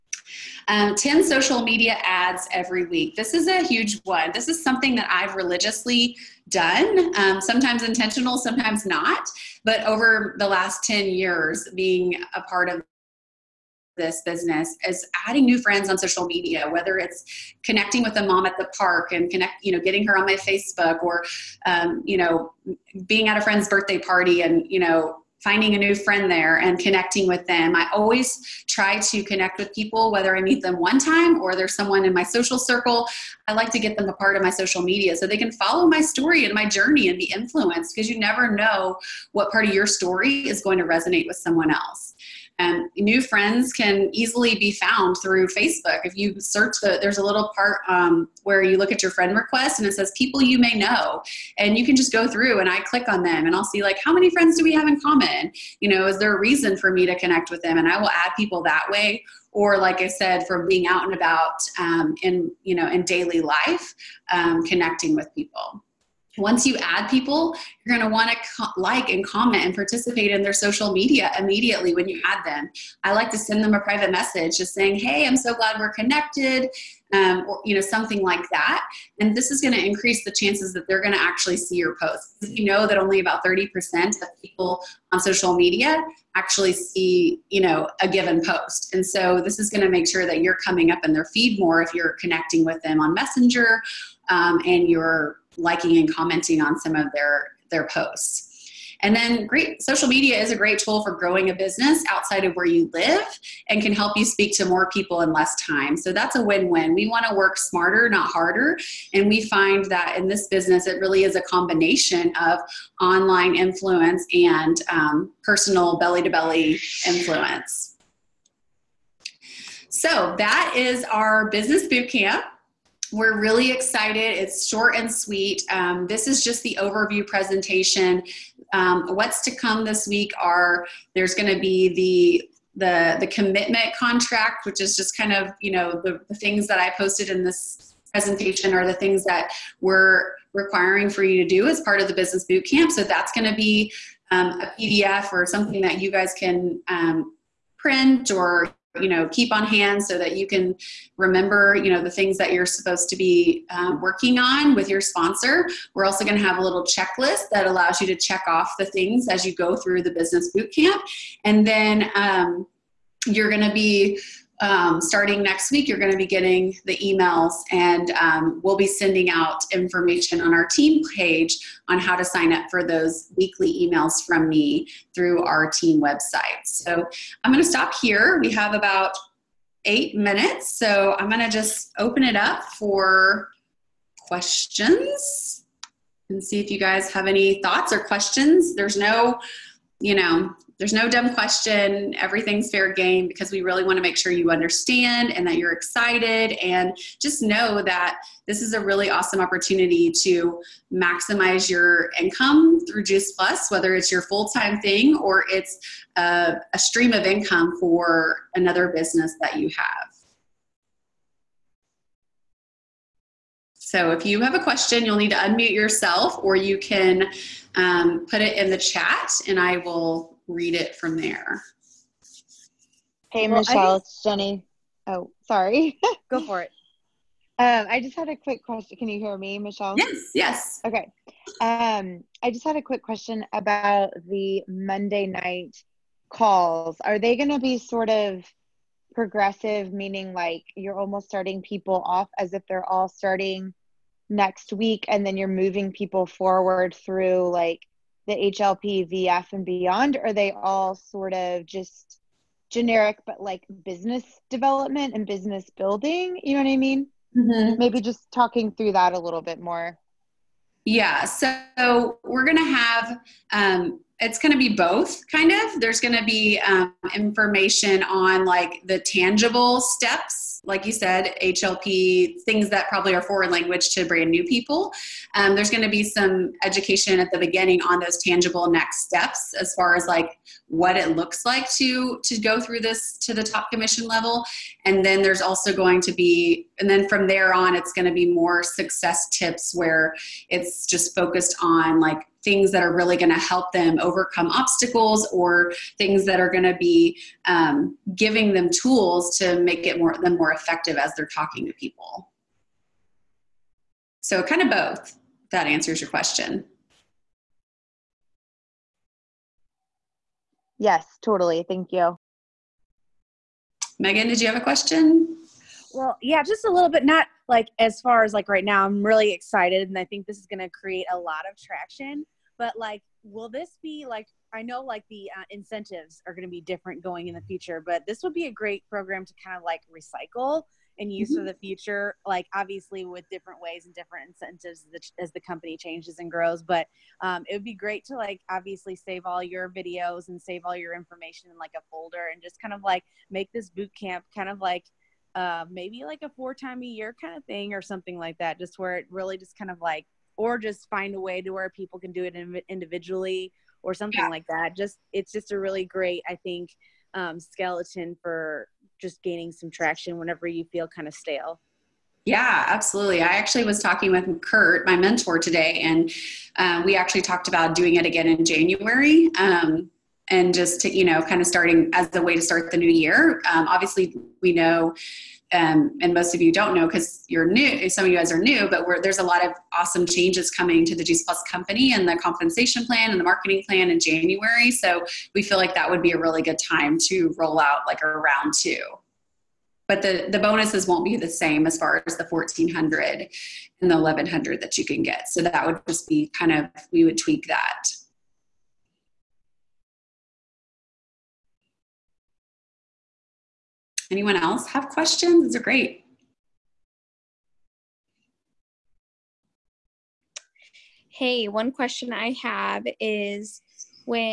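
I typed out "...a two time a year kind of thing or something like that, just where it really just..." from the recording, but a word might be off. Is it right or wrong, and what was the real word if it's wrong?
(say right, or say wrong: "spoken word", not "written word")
wrong: "four", not "two".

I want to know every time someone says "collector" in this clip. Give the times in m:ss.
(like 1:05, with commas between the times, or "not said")
not said.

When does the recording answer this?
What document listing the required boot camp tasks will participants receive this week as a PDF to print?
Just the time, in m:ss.
2:13.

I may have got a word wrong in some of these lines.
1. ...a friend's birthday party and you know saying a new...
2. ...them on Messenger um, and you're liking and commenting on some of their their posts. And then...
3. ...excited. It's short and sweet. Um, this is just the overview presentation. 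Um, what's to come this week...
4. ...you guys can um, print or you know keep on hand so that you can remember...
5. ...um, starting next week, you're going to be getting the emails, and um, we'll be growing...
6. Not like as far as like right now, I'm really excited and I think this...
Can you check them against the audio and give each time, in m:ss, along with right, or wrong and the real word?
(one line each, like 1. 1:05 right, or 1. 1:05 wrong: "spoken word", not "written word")
1. 0:23 wrong: "finding", not "saying"
2. 1:32 right
3. 2:03 right
4. 2:25 right
5. 2:44 wrong: "sending", not "growing"
6. 5:17 right.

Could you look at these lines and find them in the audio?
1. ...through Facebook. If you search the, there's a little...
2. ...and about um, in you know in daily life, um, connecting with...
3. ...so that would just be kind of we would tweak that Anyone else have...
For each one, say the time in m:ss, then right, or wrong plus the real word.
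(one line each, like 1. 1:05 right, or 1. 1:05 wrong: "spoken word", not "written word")
1. 0:45 right
2. 1:01 right
3. 6:35 right.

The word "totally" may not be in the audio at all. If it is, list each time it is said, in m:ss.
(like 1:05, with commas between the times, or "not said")
5:11.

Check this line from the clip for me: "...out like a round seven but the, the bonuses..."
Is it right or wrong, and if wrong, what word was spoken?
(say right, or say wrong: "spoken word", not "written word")
wrong: "two", not "seven".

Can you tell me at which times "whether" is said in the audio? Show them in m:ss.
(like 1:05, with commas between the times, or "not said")
0:16, 0:30, 3:23.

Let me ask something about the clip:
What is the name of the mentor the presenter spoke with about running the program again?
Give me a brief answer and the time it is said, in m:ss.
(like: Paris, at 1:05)
Kurt, at 6:04.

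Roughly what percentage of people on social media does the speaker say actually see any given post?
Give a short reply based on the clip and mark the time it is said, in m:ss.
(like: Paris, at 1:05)
30%, at 1:23.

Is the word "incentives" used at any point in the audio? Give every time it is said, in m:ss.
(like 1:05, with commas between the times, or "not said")
5:25, 5:34.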